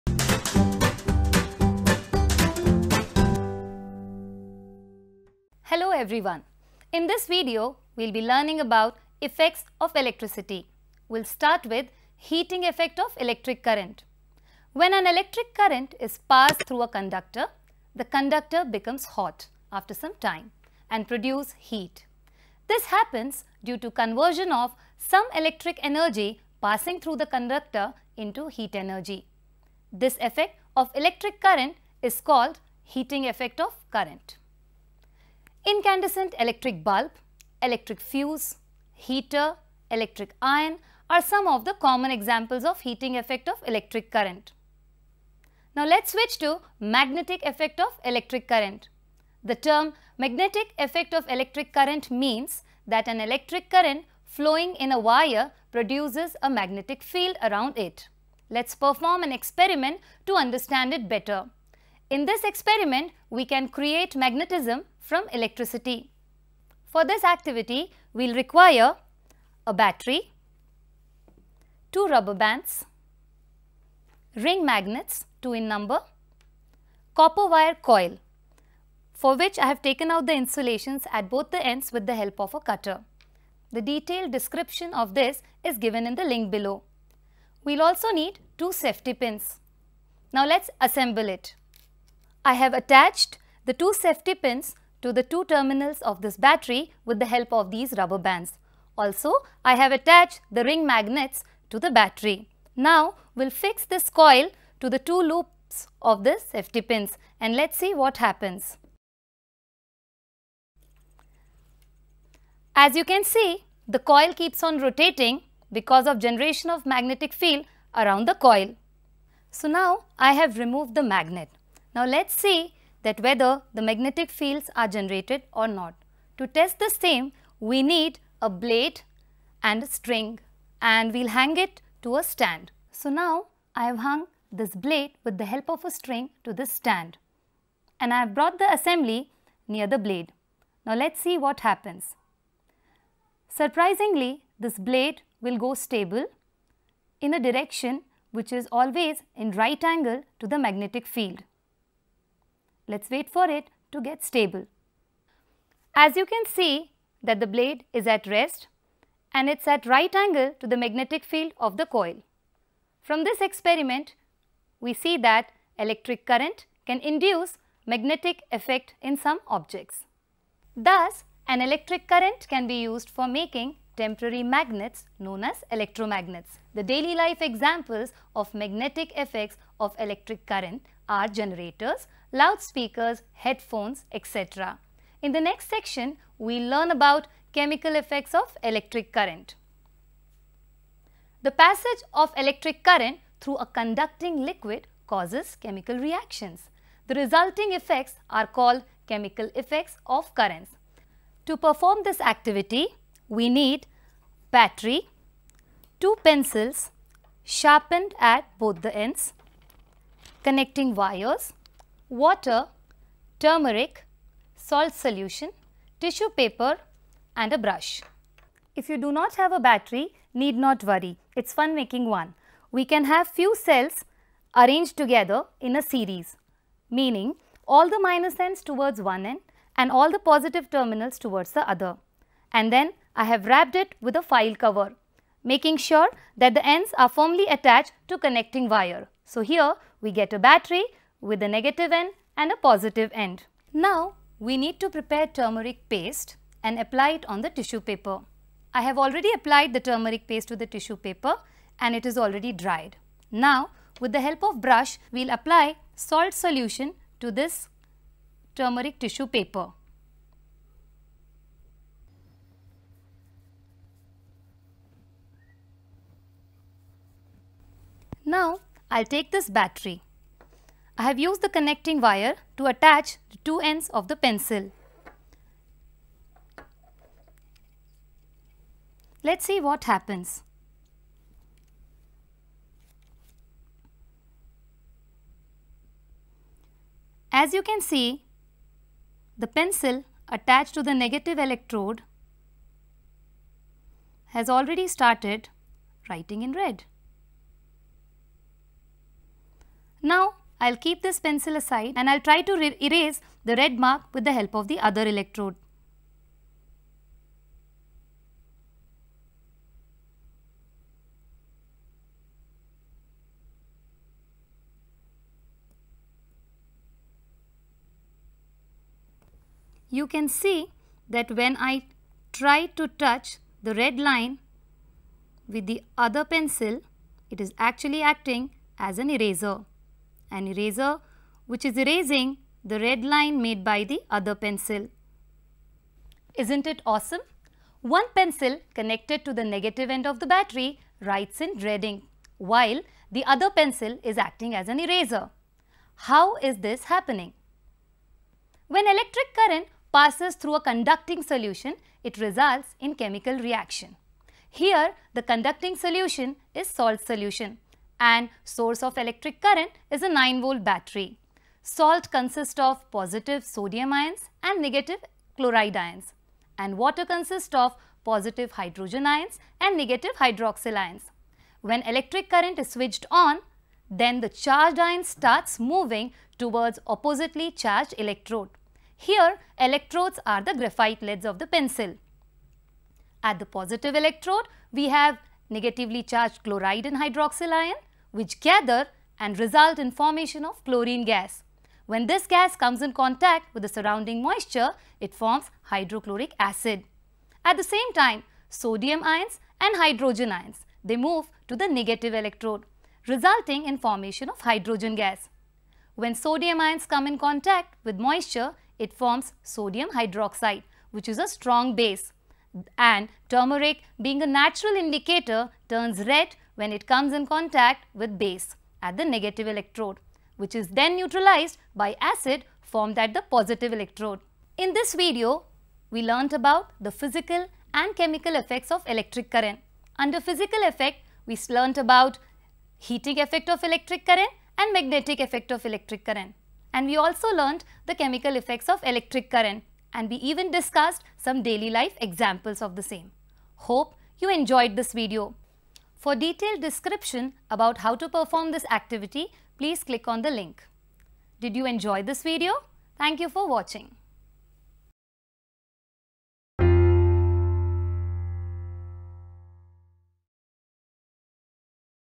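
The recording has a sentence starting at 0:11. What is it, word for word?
We'll start with heating effect of electric current.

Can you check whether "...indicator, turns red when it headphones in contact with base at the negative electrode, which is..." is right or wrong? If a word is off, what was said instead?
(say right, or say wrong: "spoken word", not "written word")
wrong: "comes", not "headphones".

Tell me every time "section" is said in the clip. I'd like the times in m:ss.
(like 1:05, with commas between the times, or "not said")
3:05.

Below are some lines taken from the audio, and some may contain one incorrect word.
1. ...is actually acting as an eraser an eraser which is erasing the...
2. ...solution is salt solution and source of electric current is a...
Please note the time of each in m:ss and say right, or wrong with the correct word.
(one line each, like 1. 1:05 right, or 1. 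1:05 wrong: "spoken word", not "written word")
1. 5:27 right
2. 5:55 right.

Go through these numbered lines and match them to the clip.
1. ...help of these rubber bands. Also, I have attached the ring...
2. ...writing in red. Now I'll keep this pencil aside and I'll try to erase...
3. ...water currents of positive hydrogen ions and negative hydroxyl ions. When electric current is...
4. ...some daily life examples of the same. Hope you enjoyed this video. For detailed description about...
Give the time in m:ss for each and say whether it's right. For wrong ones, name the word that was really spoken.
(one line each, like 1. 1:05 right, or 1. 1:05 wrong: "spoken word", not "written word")
1. 1:37 right
2. 4:56 right
3. 6:06 wrong: "consists", not "currents"
4. 7:21 right.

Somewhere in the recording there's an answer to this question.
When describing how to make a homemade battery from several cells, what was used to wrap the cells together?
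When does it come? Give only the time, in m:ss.
3:54.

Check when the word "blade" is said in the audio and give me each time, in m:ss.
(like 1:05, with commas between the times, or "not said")
2:08, 2:14, 2:19, 2:24, 2:37.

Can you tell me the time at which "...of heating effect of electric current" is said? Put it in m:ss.
0:42.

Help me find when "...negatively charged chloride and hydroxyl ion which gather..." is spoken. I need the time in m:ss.
6:25.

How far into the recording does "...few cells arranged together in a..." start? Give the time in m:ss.
3:43.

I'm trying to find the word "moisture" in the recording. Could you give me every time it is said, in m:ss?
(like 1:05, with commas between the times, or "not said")
6:34, 6:47.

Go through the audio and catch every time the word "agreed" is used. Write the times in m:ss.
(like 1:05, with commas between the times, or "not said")
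not said.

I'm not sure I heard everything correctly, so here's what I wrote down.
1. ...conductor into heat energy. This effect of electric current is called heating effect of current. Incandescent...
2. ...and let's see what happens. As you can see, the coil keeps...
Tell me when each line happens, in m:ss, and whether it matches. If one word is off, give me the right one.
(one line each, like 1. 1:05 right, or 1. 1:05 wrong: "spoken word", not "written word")
1. 0:27 right
2. 1:47 right.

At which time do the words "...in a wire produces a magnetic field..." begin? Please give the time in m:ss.
0:54.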